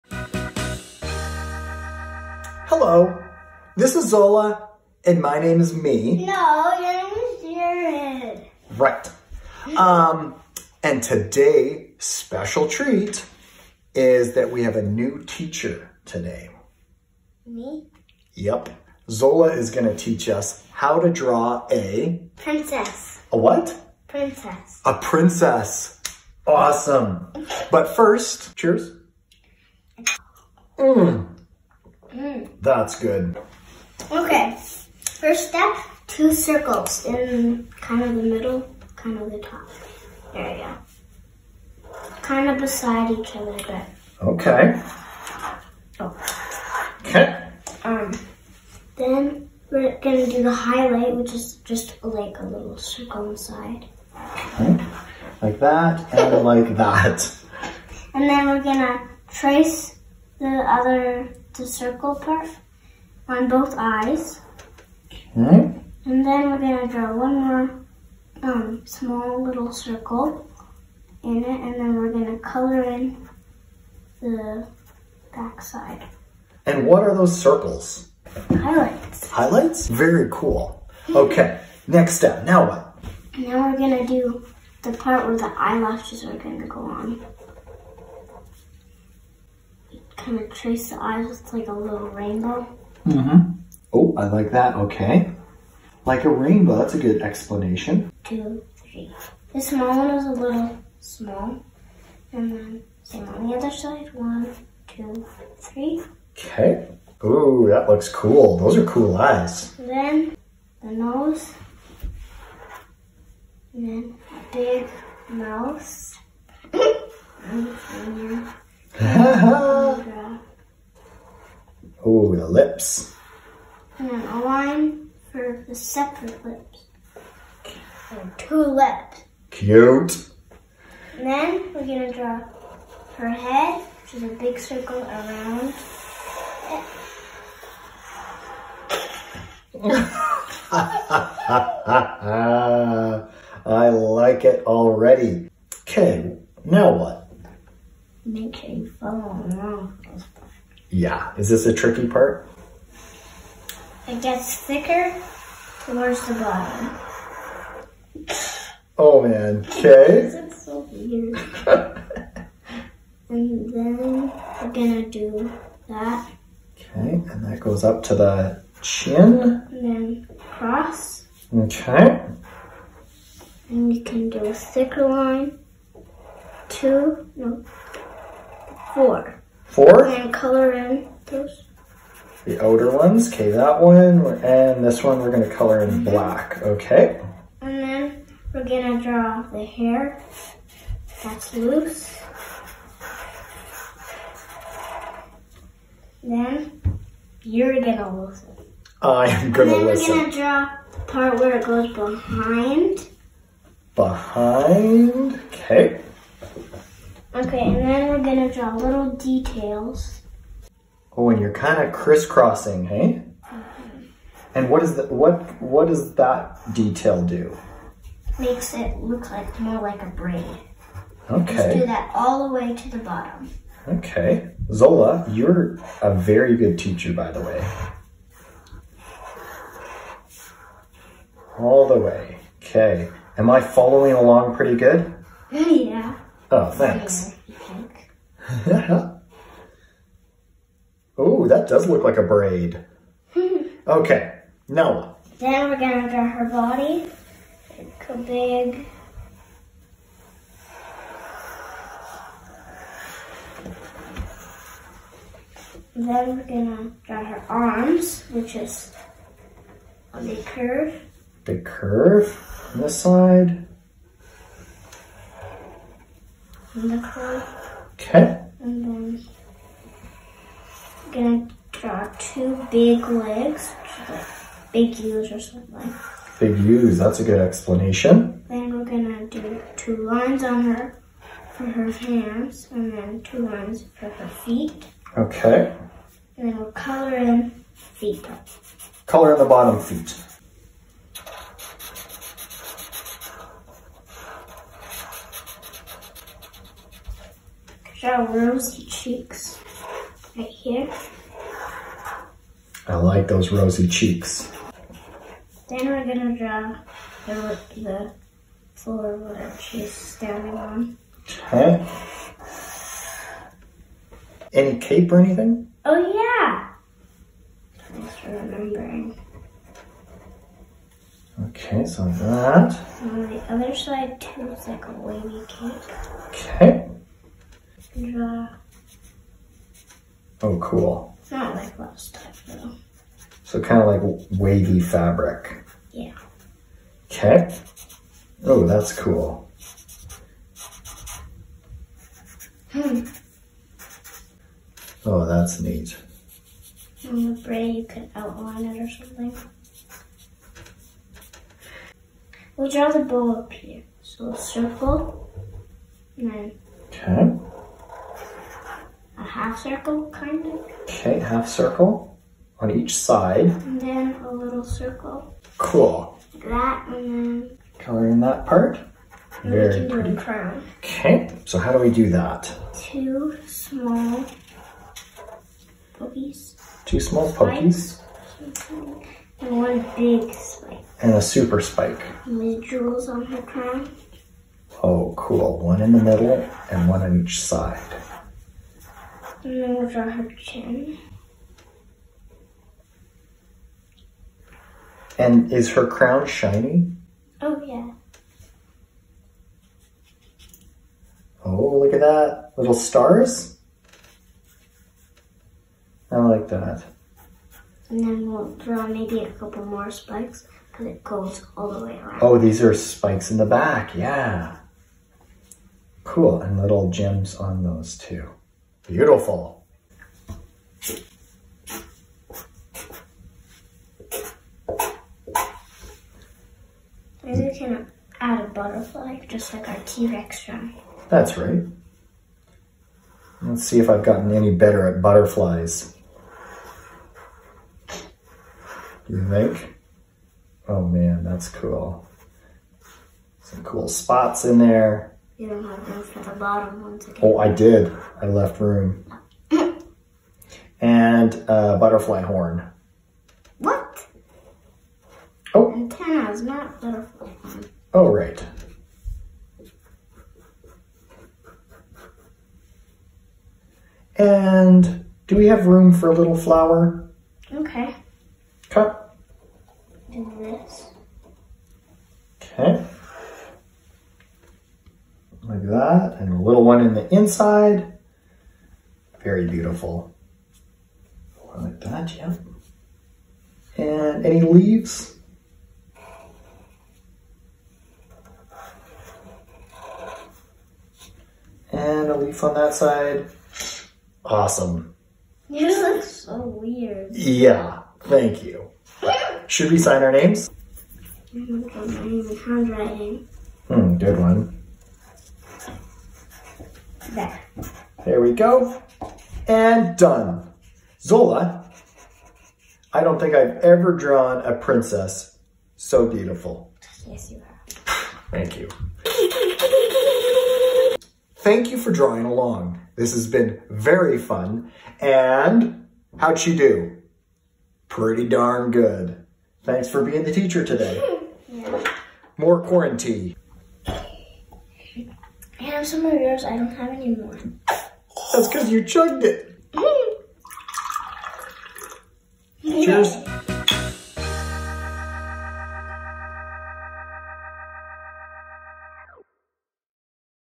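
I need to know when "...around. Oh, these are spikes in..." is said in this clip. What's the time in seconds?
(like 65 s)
411 s.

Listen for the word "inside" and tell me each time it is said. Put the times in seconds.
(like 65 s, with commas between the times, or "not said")
53 s, 477 s.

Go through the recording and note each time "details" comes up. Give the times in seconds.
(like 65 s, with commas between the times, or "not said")
209 s, 216 s.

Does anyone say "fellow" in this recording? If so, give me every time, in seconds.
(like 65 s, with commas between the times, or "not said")
not said.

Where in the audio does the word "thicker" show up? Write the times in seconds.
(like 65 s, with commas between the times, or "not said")
154 s, 174 s.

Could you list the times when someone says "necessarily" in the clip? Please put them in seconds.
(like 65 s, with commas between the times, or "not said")
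not said.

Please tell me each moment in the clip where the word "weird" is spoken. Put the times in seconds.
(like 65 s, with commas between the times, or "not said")
160 s, 496 s.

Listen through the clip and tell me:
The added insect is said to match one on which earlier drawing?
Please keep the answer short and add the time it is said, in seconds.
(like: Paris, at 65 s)
T-Rex drum, at 429 s.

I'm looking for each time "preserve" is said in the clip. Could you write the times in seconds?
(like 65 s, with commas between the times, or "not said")
not said.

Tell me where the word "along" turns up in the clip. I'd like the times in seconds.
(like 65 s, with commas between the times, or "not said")
234 s, 522 s.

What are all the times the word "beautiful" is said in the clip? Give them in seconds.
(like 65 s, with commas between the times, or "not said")
418 s, 479 s, 516 s.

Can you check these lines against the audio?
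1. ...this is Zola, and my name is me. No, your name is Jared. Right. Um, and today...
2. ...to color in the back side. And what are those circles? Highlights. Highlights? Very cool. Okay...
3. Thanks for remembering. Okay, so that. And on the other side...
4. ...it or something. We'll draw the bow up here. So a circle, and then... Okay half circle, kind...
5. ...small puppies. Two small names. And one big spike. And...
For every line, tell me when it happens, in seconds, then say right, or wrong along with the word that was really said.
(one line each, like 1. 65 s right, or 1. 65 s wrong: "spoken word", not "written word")
1. 3 s right
2. 72 s right
3. 317 s right
4. 348 s right
5. 373 s wrong: "puppies", not "names".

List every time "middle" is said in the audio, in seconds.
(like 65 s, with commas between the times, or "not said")
38 s, 386 s.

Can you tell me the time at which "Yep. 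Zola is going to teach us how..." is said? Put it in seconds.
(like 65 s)
18 s.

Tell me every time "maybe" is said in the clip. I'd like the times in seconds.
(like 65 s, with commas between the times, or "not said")
408 s, 427 s.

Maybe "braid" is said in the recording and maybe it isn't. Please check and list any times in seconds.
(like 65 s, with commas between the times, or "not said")
220 s, 242 s, 347 s.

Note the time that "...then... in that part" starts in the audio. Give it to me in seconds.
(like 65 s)
367 s.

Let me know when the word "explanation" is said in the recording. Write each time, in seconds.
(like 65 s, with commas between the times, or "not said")
97 s, 277 s.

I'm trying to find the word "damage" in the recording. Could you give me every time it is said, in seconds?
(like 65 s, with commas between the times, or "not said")
not said.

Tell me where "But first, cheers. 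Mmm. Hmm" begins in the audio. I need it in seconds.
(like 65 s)
27 s.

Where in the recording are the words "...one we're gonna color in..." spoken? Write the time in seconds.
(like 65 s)
185 s.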